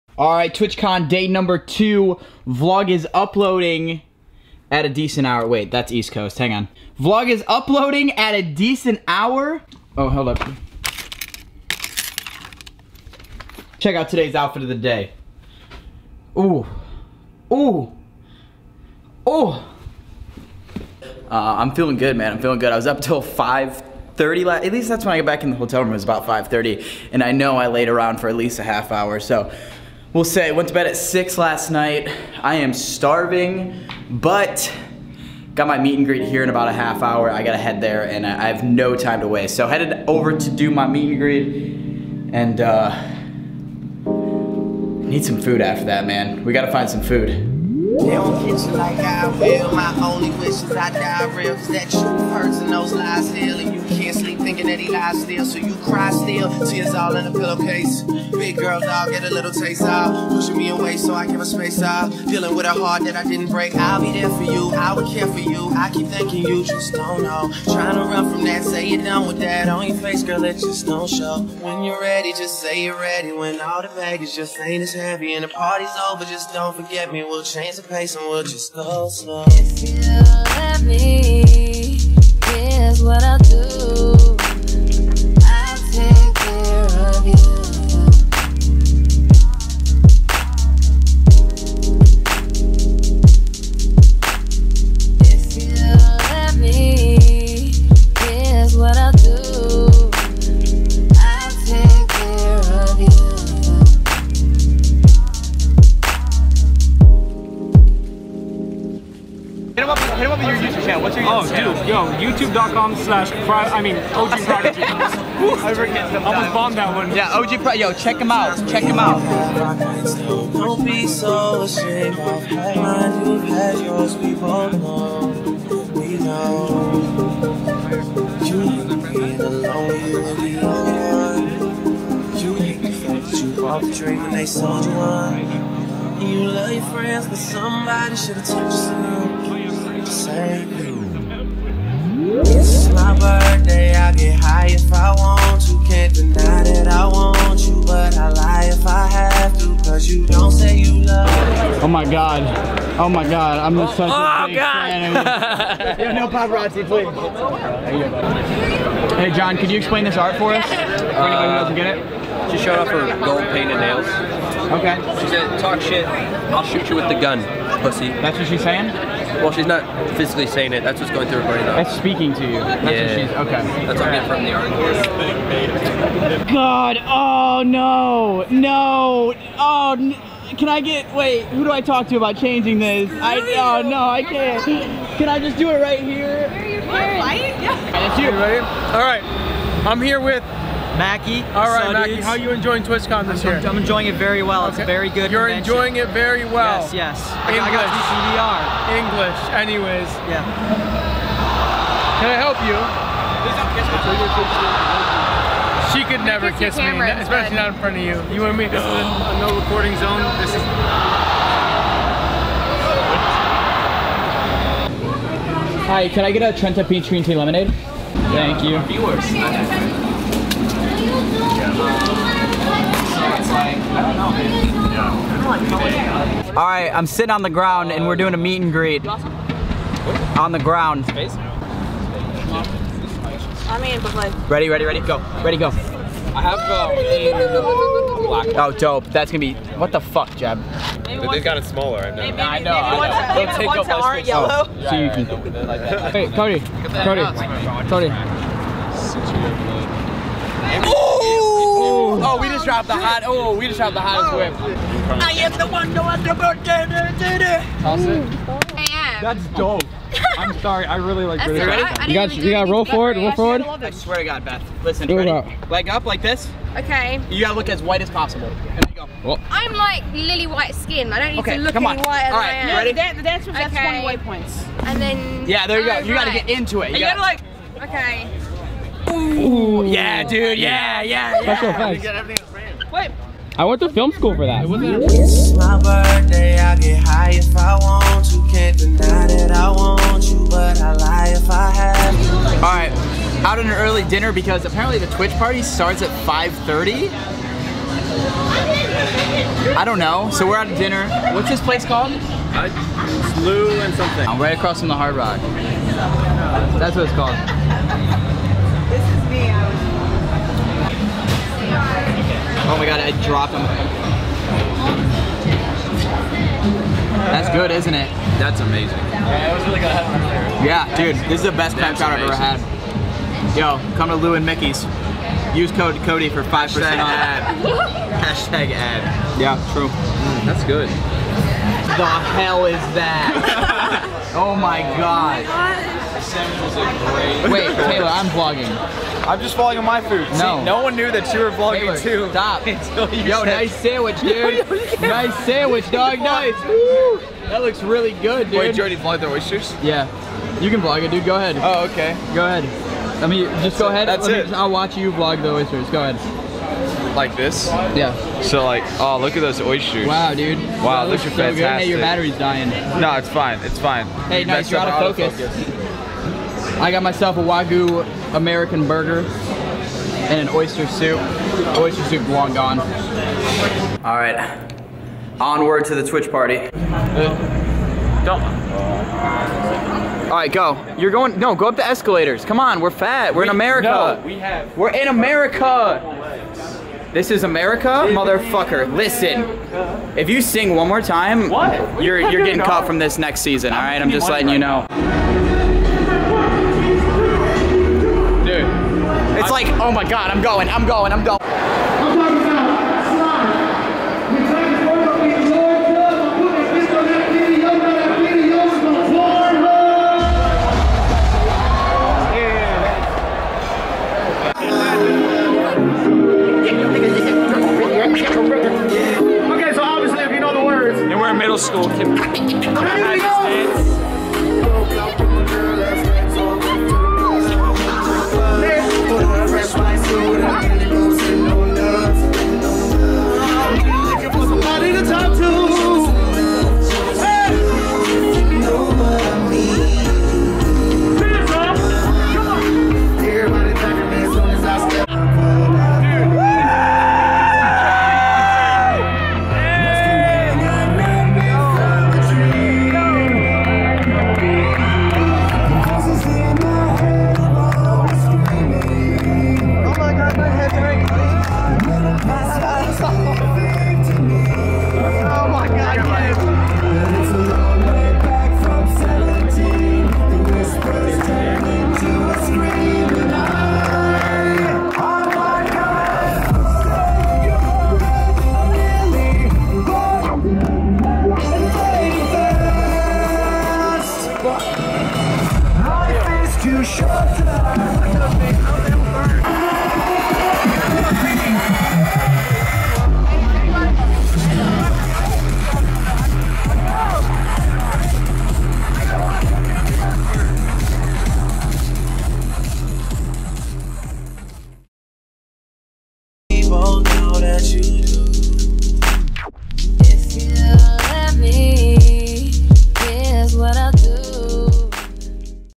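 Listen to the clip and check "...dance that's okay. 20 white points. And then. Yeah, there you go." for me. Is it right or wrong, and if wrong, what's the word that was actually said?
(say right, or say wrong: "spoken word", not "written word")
right.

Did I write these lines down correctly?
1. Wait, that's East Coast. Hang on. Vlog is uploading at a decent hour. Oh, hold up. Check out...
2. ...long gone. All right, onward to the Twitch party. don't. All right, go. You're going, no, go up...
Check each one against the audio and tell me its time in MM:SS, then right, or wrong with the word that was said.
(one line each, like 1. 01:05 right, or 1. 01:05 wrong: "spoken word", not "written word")
1. 00:05 right
2. 06:12 right.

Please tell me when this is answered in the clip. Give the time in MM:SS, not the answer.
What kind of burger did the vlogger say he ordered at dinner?
06:07.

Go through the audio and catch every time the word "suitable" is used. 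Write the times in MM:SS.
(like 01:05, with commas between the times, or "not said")
not said.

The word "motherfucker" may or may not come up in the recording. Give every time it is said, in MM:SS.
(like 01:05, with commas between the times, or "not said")
06:28.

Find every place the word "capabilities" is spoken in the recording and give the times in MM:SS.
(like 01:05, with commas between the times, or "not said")
not said.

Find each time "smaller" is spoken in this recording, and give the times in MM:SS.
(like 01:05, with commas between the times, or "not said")
04:01.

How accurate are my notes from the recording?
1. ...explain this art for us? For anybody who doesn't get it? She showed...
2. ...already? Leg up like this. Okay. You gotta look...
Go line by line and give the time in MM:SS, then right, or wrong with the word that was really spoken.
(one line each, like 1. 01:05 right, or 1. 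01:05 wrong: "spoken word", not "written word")
1. 02:39 right
2. 04:25 wrong: "ready", not "already".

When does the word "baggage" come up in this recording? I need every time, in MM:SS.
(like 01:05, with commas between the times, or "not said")
01:13.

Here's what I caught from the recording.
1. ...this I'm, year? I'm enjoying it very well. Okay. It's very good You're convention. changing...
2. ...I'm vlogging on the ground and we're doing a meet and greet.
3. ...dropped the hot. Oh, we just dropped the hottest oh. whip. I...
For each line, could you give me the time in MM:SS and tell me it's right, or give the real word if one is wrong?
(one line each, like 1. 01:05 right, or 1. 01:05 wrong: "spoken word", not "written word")
1. 03:13 wrong: "enjoying", not "changing"
2. 03:46 wrong: "sitting", not "vlogging"
3. 04:12 right.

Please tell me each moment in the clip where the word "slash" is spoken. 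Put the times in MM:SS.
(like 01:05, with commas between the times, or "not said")
01:52.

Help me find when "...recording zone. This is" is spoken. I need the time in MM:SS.
03:29.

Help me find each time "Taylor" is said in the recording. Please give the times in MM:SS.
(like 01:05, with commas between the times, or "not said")
05:37, 05:41.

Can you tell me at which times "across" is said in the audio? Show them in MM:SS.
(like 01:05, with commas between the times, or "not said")
05:04.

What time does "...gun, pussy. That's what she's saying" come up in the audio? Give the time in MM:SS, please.
02:47.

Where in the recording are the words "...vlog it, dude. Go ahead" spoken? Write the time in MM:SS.
05:50.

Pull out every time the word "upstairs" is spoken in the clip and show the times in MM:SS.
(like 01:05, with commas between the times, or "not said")
not said.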